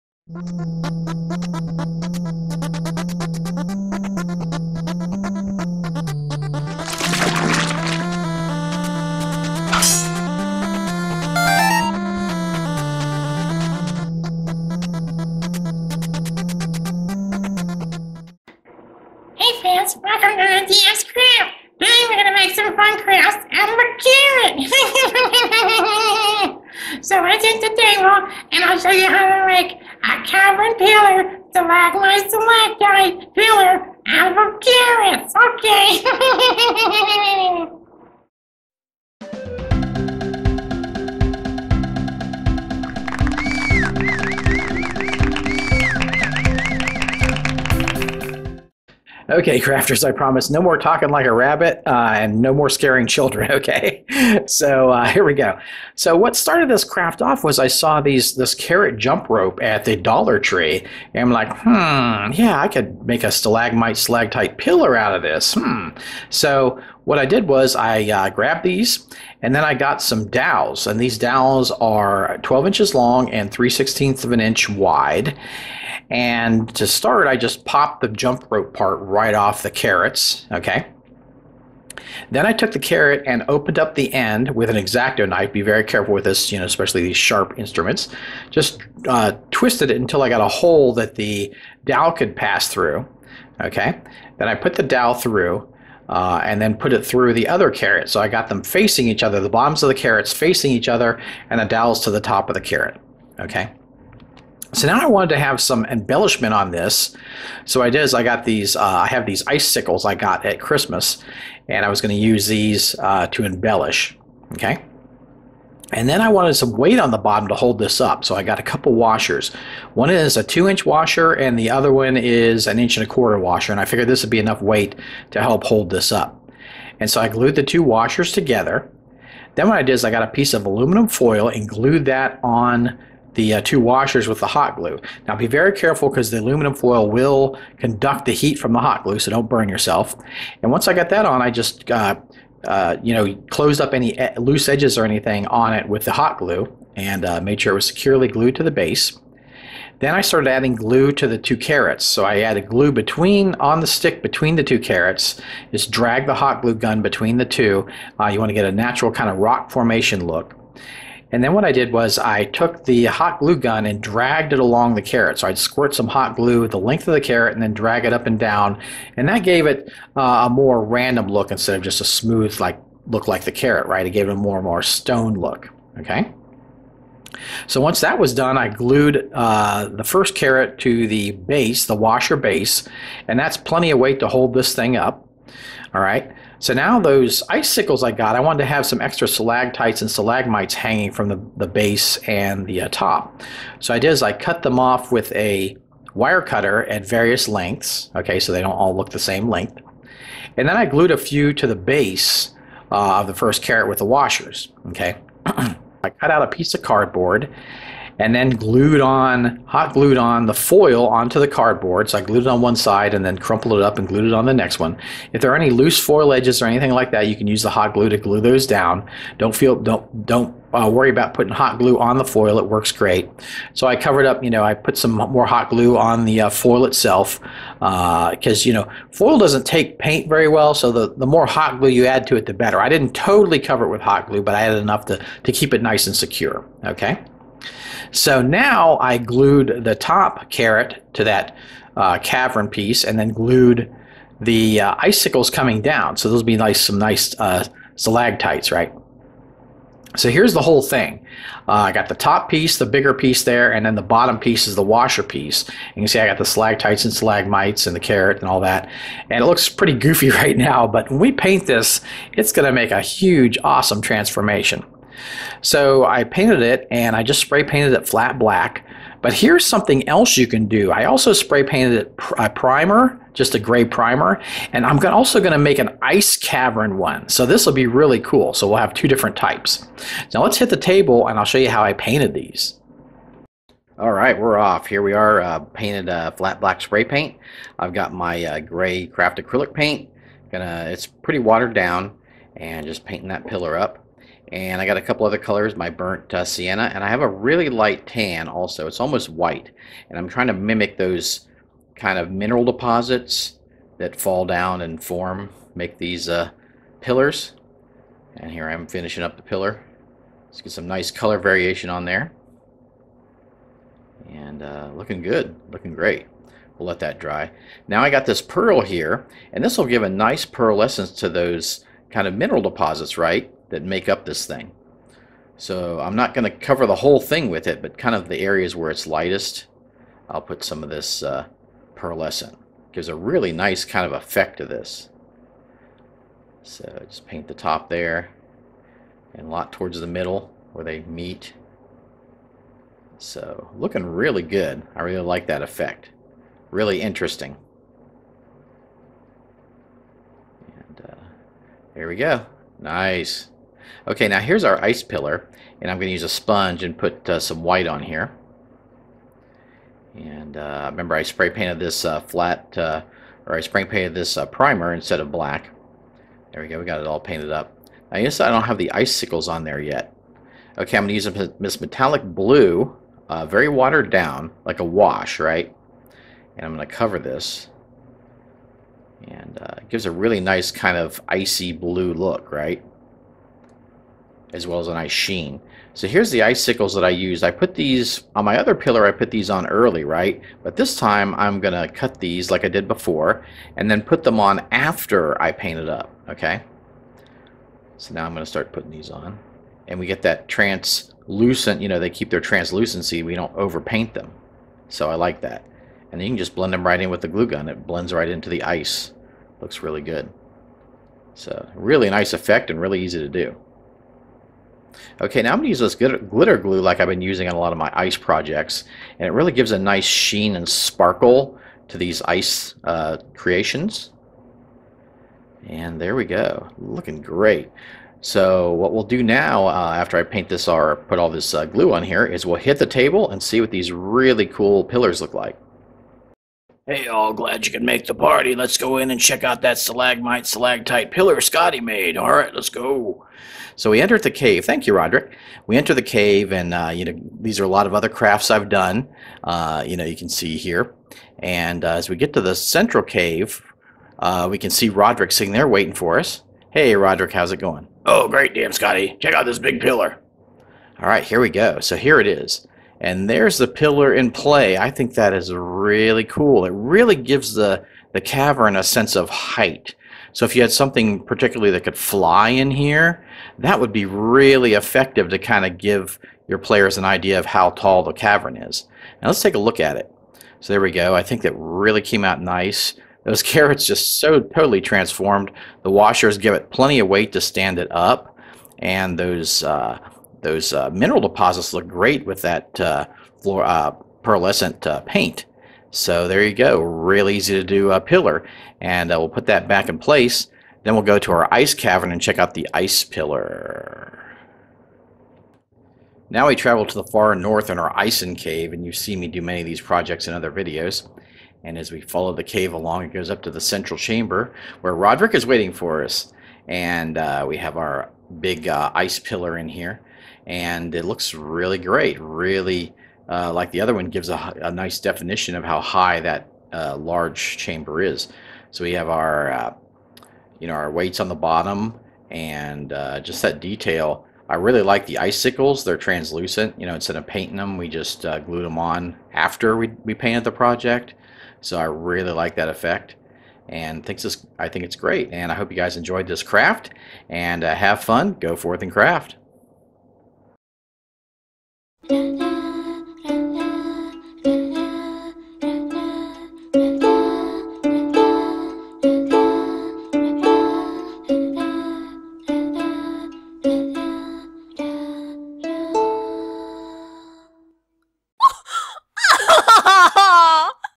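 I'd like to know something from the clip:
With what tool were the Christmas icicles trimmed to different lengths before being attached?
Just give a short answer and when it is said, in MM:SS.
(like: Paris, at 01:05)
wire cutter, at 03:16.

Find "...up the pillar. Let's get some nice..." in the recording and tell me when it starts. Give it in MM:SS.
05:09.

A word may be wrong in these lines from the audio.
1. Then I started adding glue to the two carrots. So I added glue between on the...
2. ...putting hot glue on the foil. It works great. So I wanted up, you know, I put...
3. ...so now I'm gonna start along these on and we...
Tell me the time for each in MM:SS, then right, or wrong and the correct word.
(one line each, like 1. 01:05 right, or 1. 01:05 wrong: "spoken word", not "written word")
1. 02:29 right
2. 03:41 wrong: "covered", not "wanted"
3. 06:37 wrong: "putting", not "along".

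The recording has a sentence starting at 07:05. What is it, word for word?
And there we go, looking great.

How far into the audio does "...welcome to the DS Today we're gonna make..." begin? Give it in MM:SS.
00:19.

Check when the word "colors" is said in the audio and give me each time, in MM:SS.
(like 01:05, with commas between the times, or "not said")
04:55, 05:11.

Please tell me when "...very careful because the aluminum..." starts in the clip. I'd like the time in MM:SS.
02:15.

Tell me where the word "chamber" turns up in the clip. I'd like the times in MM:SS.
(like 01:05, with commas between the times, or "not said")
08:33, 08:47.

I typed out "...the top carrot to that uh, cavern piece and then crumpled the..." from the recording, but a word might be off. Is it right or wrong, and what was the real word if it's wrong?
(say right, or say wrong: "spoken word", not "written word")
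wrong: "glued", not "crumpled".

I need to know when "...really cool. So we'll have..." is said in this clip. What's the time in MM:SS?
04:37.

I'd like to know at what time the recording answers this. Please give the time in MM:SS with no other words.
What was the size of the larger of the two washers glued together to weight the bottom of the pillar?
02:00.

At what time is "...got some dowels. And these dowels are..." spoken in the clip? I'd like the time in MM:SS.
01:09.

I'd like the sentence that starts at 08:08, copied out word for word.
And those uh, those uh, mineral deposits look great with that uh, uh, pearlescent uh, paint.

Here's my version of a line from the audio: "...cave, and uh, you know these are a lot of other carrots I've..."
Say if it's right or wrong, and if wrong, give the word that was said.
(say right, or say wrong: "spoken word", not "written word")
wrong: "crafts", not "carrots".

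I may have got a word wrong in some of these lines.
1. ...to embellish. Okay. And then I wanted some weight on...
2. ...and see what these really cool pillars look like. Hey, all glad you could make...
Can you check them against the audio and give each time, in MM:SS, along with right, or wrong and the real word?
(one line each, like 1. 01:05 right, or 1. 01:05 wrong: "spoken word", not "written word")
1. 01:53 right
2. 07:13 right.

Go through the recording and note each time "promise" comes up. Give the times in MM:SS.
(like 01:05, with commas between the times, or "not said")
00:50.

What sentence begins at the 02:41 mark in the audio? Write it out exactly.
And then what I did was I took the hot glue gun and dragged it along the carrot.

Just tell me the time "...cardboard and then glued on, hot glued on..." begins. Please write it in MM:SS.
03:26.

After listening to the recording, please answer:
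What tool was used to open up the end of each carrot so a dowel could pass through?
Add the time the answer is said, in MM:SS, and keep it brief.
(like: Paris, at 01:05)
X-Acto knife, at 01:24.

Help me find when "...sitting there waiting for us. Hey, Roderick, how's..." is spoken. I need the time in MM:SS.
07:35.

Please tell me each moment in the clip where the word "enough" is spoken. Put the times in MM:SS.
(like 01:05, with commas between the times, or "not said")
02:04, 03:54.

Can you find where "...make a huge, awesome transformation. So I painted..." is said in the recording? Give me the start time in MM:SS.
04:22.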